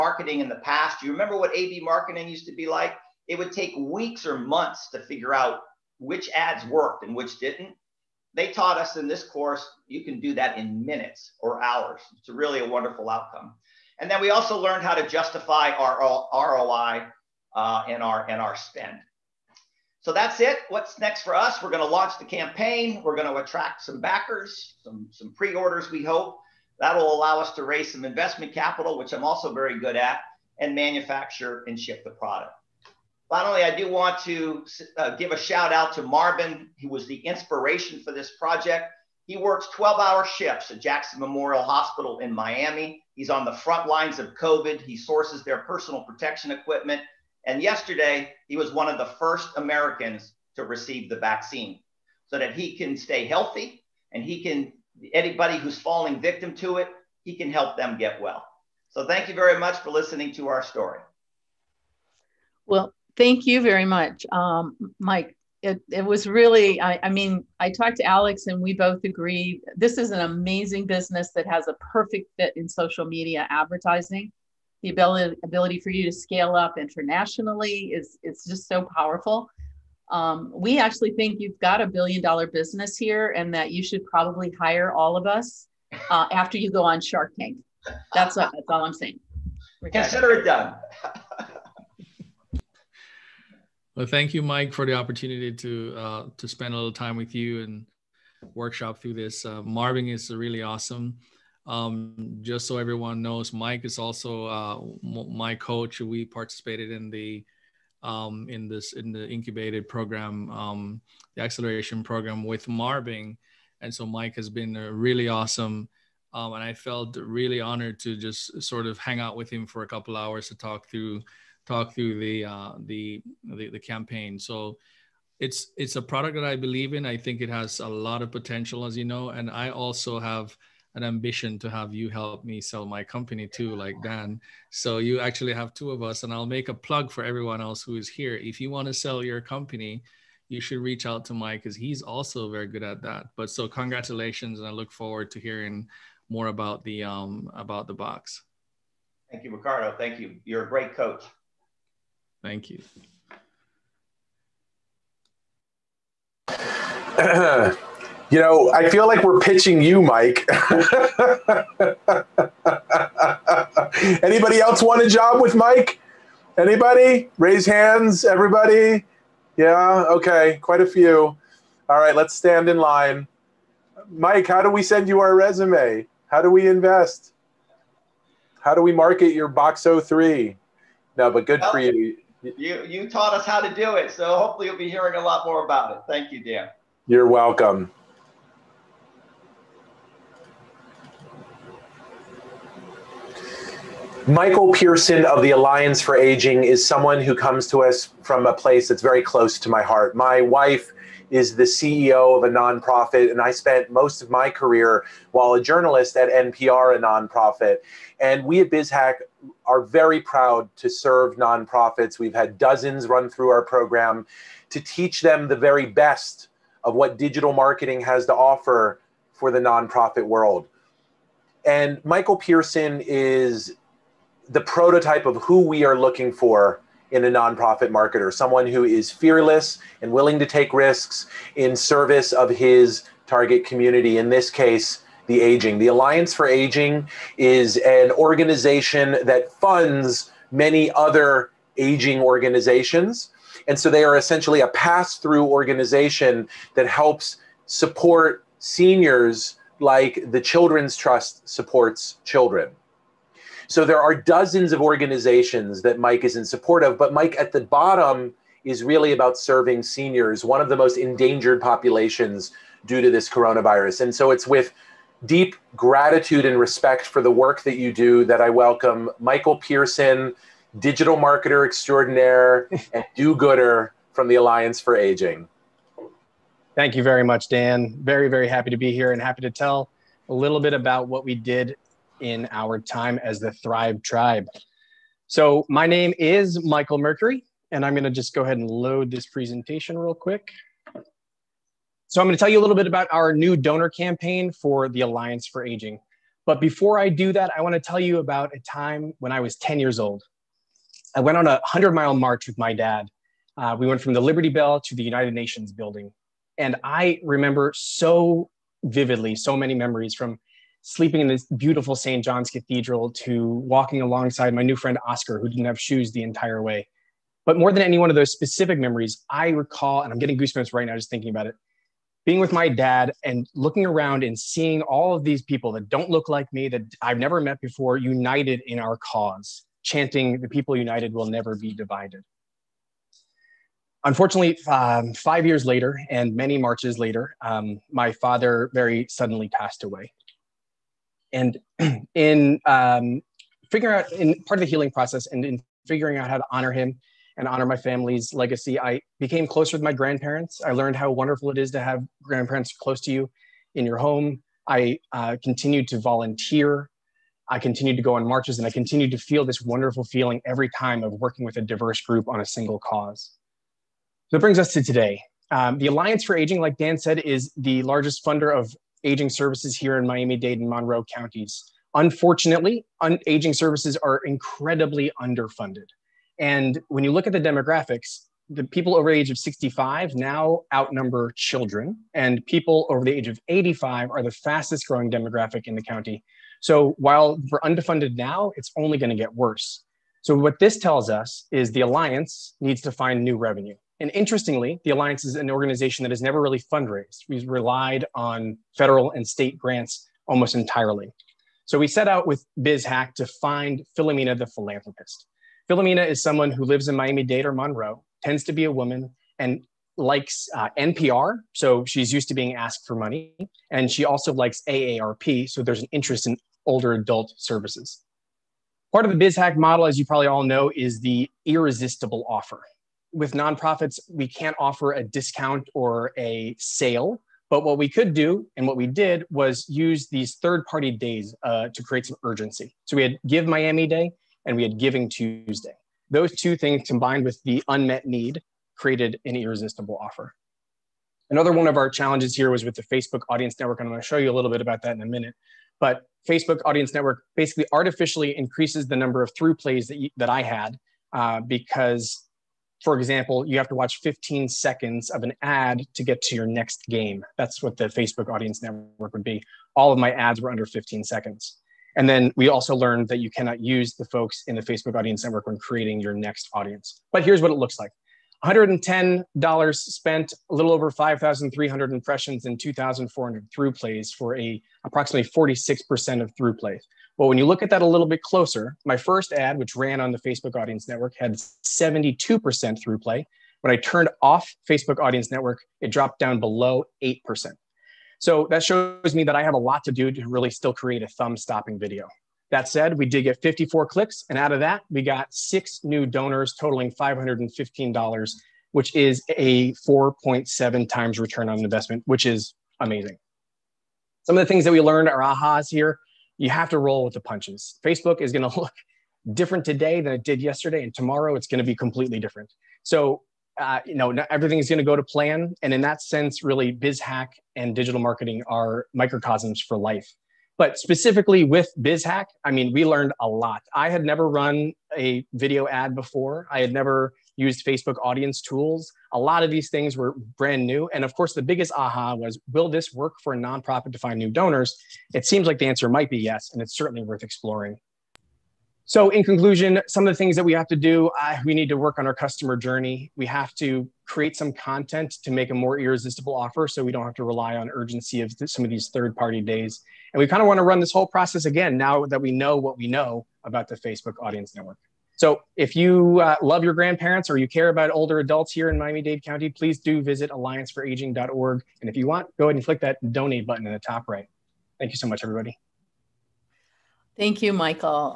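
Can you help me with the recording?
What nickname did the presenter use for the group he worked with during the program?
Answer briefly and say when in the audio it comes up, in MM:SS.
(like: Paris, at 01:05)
Thrive Tribe, at 04:43.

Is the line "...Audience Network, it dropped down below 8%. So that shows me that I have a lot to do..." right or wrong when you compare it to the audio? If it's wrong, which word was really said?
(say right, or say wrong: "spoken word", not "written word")
right.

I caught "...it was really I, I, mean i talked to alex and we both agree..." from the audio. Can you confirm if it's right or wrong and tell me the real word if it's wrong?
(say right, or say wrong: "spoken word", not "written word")
right.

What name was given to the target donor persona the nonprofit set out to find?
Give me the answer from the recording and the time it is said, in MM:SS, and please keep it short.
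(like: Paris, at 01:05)
Philomena the philanthropist, at 06:43.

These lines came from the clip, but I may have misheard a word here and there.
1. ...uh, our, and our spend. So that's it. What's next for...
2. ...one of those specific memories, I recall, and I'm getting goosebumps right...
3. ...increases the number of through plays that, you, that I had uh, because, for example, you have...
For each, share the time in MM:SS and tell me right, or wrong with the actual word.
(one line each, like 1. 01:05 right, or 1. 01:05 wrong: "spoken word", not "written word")
1. 00:17 right
2. 05:17 right
3. 07:28 right.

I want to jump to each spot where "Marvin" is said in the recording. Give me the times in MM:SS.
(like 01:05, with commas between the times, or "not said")
00:36, 01:39, 01:52.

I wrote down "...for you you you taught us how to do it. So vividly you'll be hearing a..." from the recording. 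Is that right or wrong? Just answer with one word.
wrong.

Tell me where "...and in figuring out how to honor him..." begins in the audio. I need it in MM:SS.
05:45.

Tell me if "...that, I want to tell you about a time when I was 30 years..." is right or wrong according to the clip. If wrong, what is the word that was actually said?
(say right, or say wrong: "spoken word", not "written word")
wrong: "10", not "30".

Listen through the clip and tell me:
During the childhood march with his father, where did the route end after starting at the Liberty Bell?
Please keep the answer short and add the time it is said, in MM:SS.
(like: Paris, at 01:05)
United Nations building, at 05:05.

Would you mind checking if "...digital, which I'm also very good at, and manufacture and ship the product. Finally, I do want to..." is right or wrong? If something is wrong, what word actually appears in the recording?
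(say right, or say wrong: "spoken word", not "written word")
wrong: "capital", not "digital".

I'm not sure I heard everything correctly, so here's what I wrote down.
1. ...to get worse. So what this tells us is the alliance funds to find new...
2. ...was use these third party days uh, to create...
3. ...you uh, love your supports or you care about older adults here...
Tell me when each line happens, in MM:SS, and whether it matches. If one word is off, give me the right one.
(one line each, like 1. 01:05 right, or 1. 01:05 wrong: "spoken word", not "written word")
1. 06:29 wrong: "needs", not "funds"
2. 07:09 right
3. 09:15 wrong: "grandparents", not "supports".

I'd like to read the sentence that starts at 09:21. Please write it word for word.
And if you want, go ahead and click that donate button in the top right.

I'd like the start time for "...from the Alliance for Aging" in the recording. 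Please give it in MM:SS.
04:34.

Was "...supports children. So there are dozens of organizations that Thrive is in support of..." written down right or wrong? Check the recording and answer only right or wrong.
wrong.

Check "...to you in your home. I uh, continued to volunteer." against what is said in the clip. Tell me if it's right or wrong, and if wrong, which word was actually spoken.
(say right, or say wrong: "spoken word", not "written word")
right.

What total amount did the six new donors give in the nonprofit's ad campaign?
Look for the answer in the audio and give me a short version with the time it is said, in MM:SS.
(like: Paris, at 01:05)
$515, at 08:16.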